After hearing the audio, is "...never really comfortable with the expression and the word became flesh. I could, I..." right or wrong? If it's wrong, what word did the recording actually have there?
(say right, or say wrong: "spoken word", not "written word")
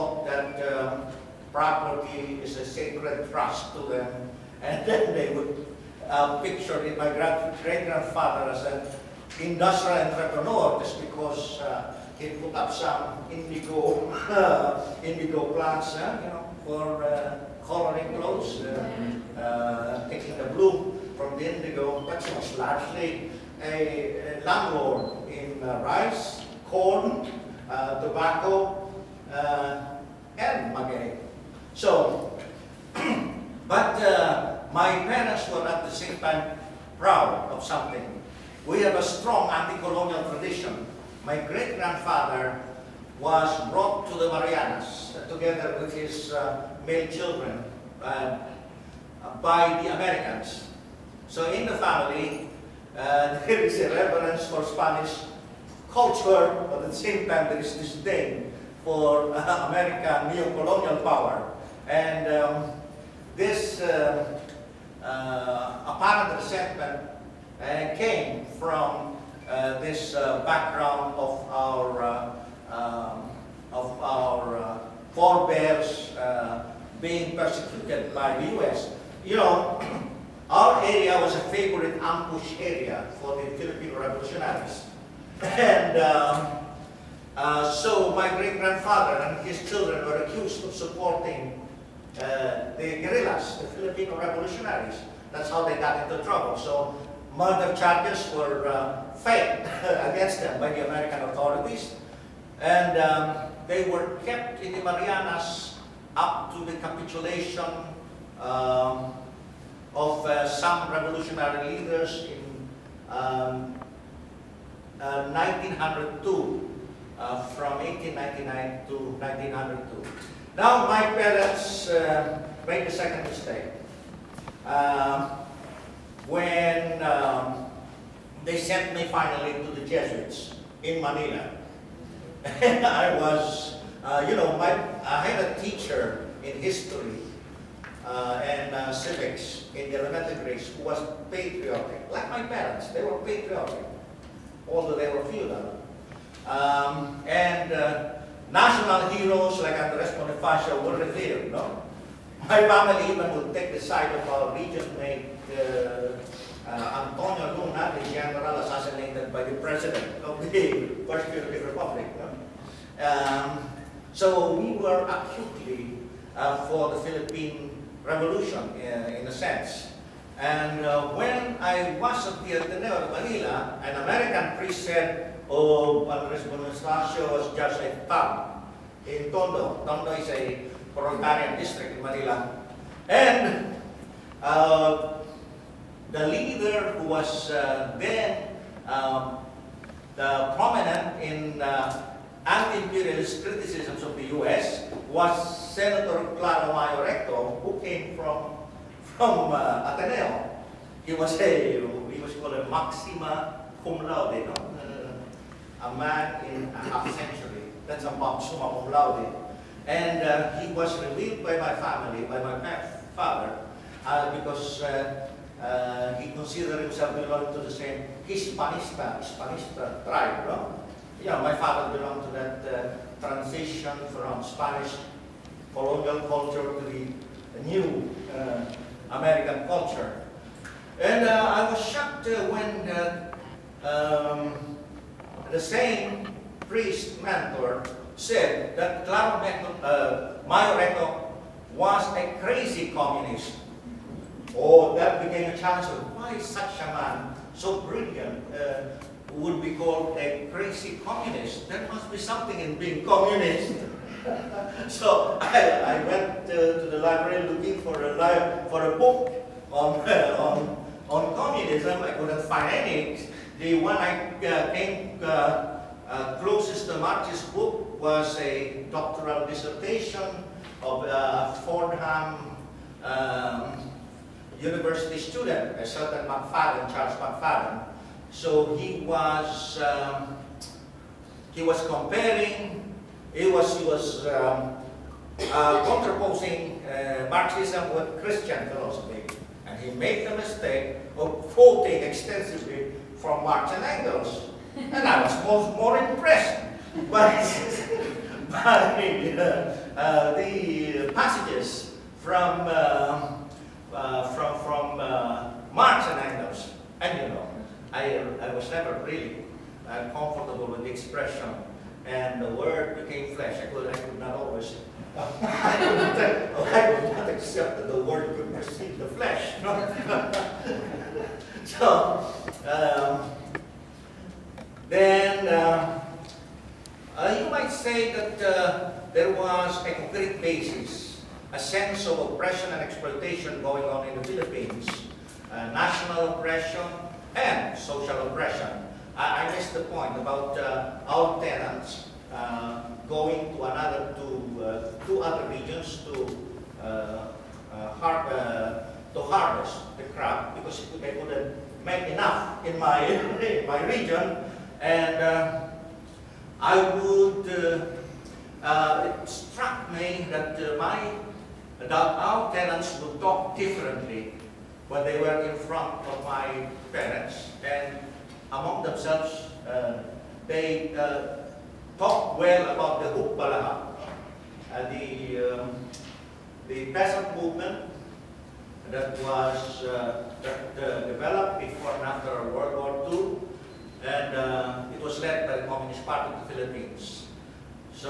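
right.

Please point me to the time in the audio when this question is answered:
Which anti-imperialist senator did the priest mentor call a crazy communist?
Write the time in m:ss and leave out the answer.
3:16.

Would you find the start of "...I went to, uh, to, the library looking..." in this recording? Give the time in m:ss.
4:15.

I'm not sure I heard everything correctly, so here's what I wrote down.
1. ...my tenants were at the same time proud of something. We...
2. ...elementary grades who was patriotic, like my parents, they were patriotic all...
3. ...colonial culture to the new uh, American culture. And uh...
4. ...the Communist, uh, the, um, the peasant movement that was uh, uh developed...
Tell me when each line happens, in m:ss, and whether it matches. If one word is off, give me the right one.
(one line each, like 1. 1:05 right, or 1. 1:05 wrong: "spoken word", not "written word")
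1. 0:34 wrong: "parents", not "tenants"
2. 2:19 right
3. 3:45 right
4. 6:13 wrong: "Hukbalahap", not "Communist".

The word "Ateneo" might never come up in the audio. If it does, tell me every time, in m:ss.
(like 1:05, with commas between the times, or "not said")
2:52, 3:19.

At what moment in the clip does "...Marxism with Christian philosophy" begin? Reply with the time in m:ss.
4:47.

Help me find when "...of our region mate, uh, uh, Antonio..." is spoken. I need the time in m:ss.
2:34.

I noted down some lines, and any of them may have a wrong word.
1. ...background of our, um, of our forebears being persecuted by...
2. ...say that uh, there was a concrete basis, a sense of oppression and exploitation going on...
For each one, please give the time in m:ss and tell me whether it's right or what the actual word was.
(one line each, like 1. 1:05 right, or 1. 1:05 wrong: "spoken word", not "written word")
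1. 1:10 right
2. 5:27 right.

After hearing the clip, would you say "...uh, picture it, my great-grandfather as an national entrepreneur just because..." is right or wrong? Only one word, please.
wrong.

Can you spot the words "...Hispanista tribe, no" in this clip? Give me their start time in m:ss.
3:39.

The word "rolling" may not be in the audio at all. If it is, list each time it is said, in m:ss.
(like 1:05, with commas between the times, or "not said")
not said.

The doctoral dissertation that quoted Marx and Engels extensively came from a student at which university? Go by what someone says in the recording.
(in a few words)
Fordham.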